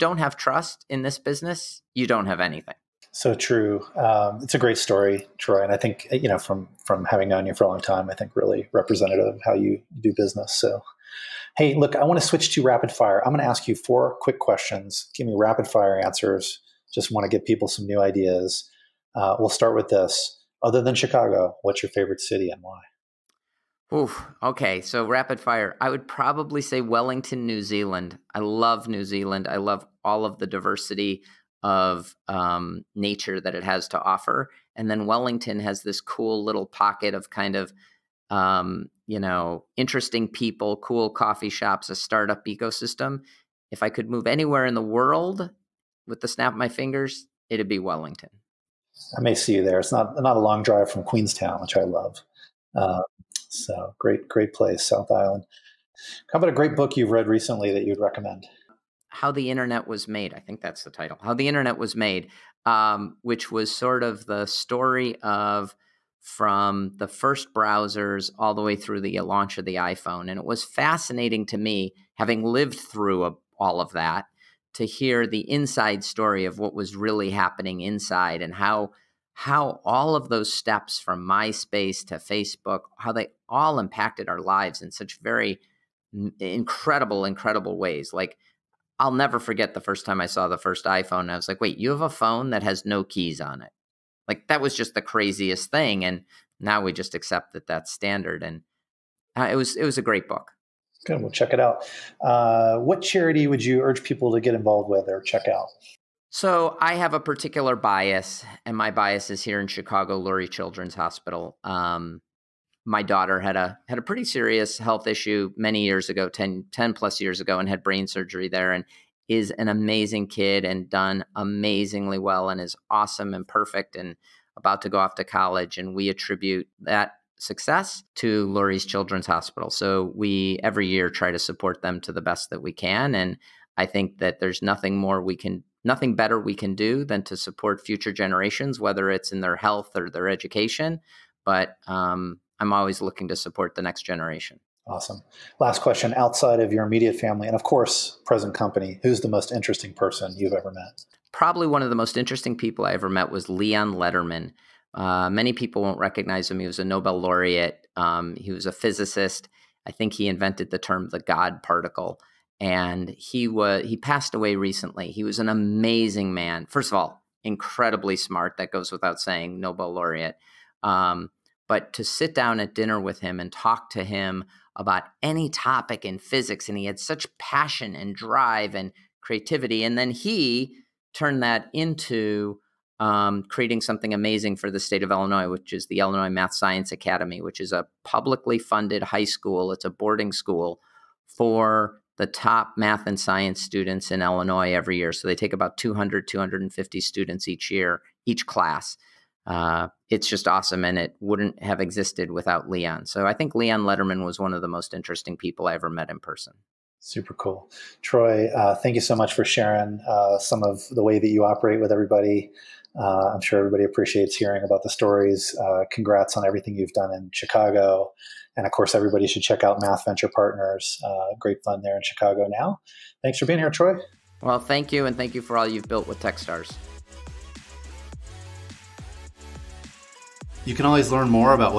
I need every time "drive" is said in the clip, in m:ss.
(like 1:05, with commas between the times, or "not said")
0:50, 2:58.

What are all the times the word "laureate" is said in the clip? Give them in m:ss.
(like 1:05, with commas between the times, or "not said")
2:37, 2:49.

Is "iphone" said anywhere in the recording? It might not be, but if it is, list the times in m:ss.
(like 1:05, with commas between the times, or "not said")
1:09, 1:30.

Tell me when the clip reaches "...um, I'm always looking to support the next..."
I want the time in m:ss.
2:21.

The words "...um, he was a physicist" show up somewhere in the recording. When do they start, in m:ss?
2:37.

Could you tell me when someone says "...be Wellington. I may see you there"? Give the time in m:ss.
0:47.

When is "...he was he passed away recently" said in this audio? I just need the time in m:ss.
2:43.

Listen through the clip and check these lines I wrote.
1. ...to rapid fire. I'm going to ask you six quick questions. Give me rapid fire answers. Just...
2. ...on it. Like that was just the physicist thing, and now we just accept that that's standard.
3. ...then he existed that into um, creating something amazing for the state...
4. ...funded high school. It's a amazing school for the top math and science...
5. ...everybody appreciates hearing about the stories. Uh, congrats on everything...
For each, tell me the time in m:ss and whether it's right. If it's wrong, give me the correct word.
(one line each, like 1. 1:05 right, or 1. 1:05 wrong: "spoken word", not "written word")
1. 0:12 wrong: "four", not "six"
2. 1:33 wrong: "craziest", not "physicist"
3. 2:59 wrong: "turned", not "existed"
4. 3:08 wrong: "boarding", not "amazing"
5. 3:33 right.